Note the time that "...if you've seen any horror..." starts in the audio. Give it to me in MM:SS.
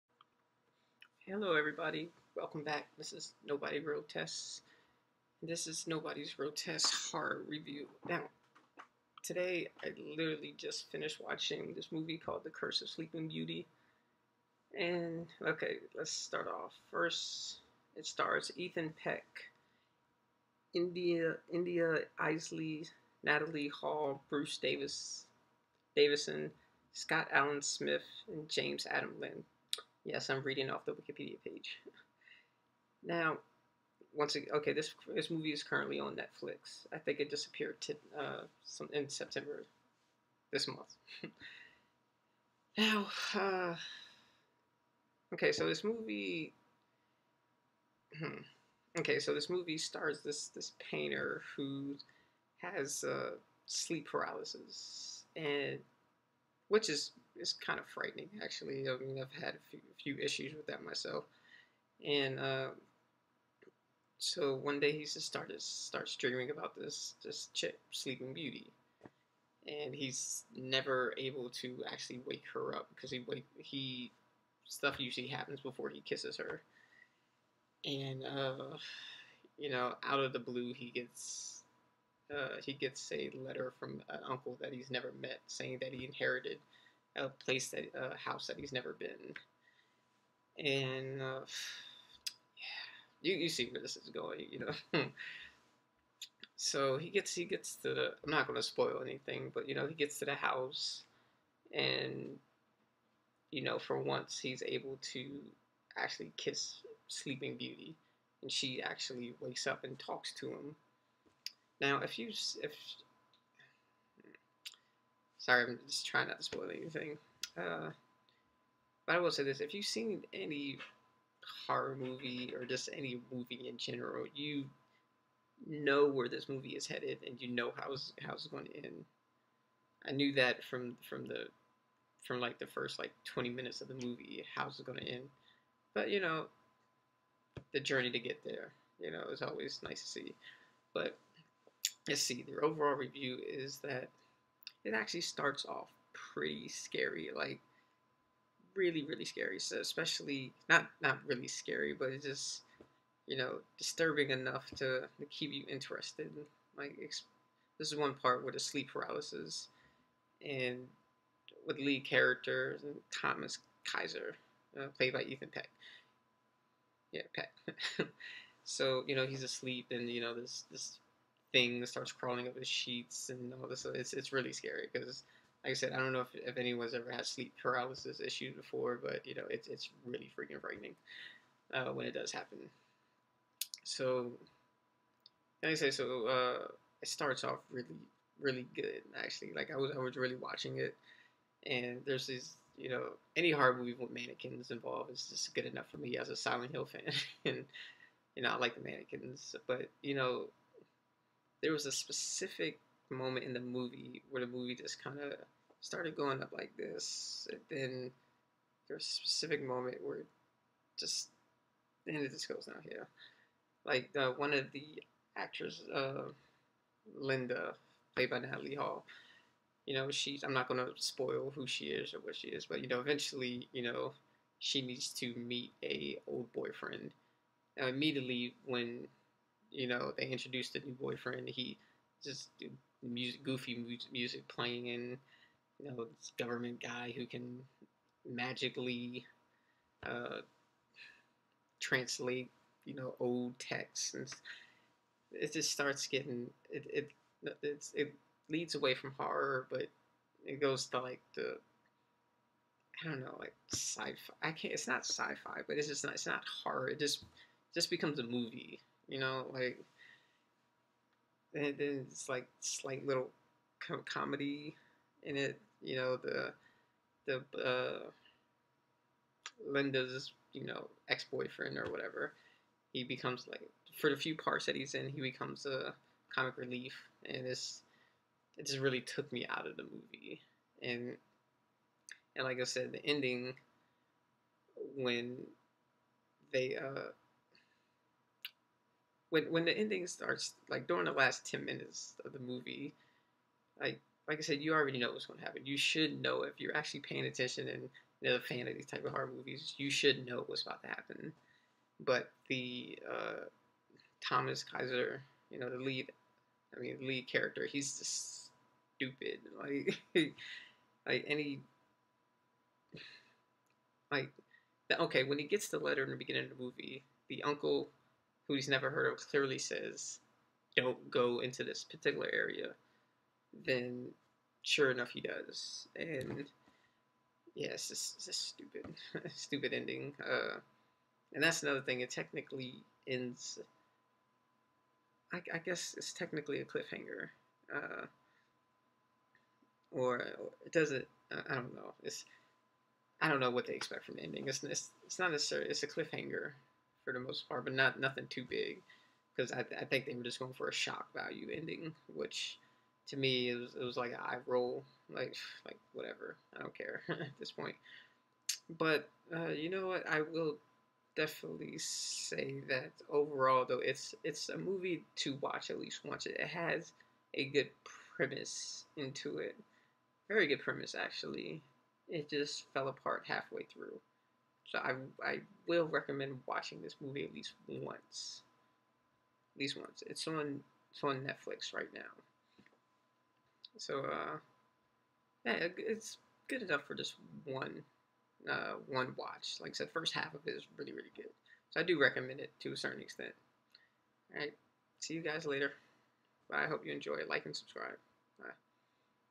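01:59.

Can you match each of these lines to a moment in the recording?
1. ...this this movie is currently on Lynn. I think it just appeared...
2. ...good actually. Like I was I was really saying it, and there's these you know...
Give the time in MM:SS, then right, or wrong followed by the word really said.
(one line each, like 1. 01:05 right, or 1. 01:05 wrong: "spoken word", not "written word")
1. 00:34 wrong: "Netflix", not "Lynn"
2. 03:08 wrong: "watching", not "saying".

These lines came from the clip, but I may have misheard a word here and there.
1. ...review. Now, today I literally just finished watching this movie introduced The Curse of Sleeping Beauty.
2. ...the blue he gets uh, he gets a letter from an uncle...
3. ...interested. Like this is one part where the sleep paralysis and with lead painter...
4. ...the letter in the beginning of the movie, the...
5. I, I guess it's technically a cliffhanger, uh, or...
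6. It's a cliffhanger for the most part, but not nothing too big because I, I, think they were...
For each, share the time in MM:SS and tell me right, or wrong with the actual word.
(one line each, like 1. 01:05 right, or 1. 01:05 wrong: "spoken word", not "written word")
1. 00:07 wrong: "called", not "introduced"
2. 01:20 right
3. 02:35 wrong: "character", not "painter"
4. 05:15 right
5. 05:35 right
6. 05:45 right.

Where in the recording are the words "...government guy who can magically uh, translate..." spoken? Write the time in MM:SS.
03:56.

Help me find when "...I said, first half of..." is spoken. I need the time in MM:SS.
06:29.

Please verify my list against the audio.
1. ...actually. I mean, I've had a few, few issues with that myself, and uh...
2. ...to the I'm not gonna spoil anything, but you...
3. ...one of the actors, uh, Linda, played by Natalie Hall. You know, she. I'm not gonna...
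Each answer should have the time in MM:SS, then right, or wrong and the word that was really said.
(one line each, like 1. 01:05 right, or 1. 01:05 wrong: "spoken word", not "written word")
1. 00:58 right
2. 01:37 right
3. 03:34 right.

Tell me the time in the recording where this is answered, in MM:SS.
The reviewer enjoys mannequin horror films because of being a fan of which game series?
03:16.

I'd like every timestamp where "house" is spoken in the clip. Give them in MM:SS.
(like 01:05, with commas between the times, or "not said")
01:28, 01:40.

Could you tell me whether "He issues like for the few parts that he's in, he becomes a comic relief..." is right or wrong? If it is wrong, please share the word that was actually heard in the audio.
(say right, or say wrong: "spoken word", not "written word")
wrong: "becomes", not "issues".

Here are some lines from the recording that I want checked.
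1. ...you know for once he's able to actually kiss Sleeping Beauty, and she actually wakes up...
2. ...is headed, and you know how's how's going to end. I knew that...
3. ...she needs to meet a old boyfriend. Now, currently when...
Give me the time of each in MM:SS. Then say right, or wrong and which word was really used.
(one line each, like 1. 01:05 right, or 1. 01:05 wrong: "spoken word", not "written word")
1. 01:43 right
2. 02:06 right
3. 03:44 wrong: "immediately", not "currently".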